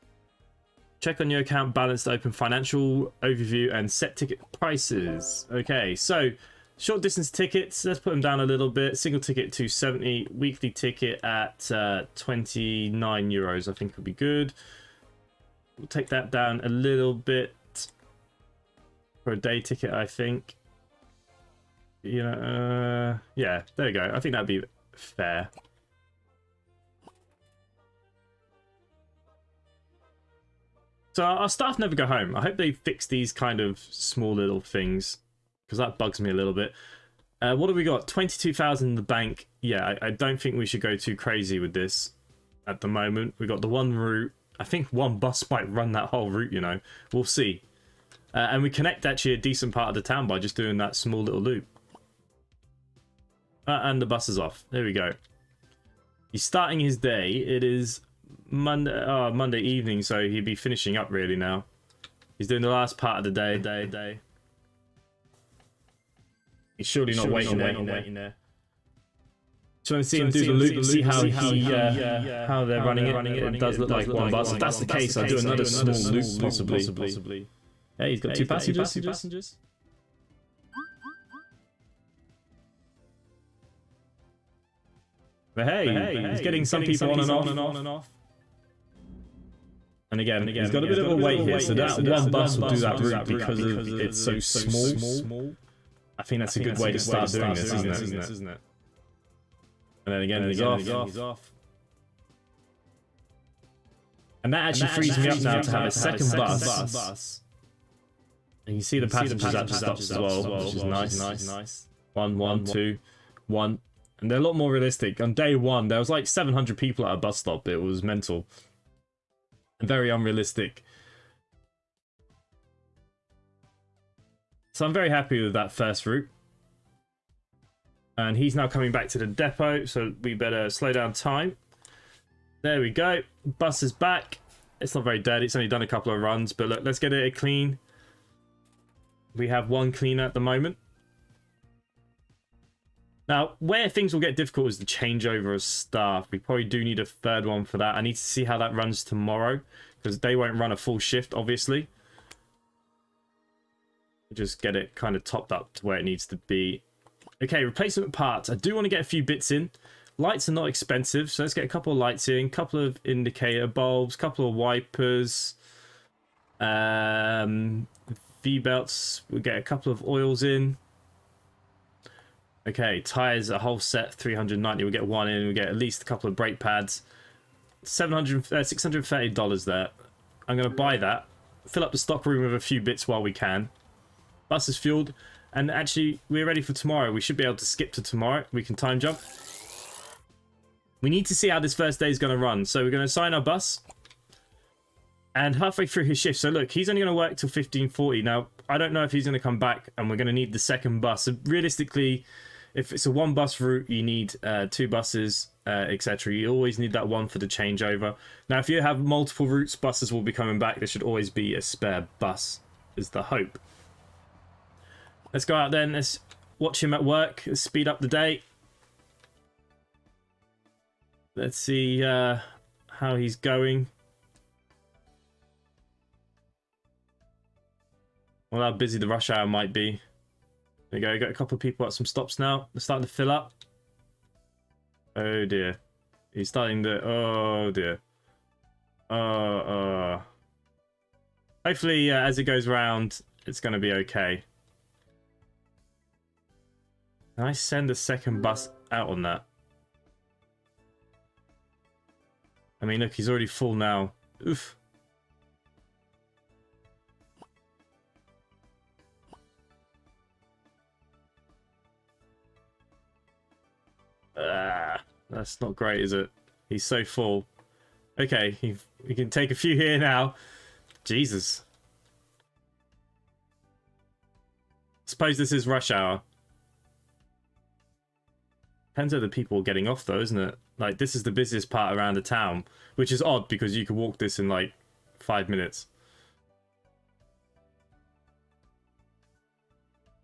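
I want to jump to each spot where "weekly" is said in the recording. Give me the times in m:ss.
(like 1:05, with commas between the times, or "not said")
0:10.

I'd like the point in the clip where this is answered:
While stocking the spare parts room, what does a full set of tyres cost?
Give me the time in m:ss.
2:54.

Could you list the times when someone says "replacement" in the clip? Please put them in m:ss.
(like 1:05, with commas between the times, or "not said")
2:37.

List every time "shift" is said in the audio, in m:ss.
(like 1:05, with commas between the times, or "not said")
2:30, 3:16.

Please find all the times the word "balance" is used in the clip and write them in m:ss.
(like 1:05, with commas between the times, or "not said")
0:01.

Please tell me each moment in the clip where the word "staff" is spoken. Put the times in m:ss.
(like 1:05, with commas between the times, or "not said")
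0:31, 2:25.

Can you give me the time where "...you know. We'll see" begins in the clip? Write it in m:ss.
0:46.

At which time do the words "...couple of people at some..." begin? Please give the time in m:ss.
3:51.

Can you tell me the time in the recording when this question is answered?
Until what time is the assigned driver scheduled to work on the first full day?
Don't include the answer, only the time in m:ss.
3:17.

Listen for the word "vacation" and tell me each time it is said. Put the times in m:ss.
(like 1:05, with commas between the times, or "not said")
not said.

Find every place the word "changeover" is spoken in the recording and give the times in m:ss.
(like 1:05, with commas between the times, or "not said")
2:24, 3:27.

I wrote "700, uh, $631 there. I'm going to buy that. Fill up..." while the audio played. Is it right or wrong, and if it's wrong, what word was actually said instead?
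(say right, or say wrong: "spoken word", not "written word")
wrong: "630", not "631".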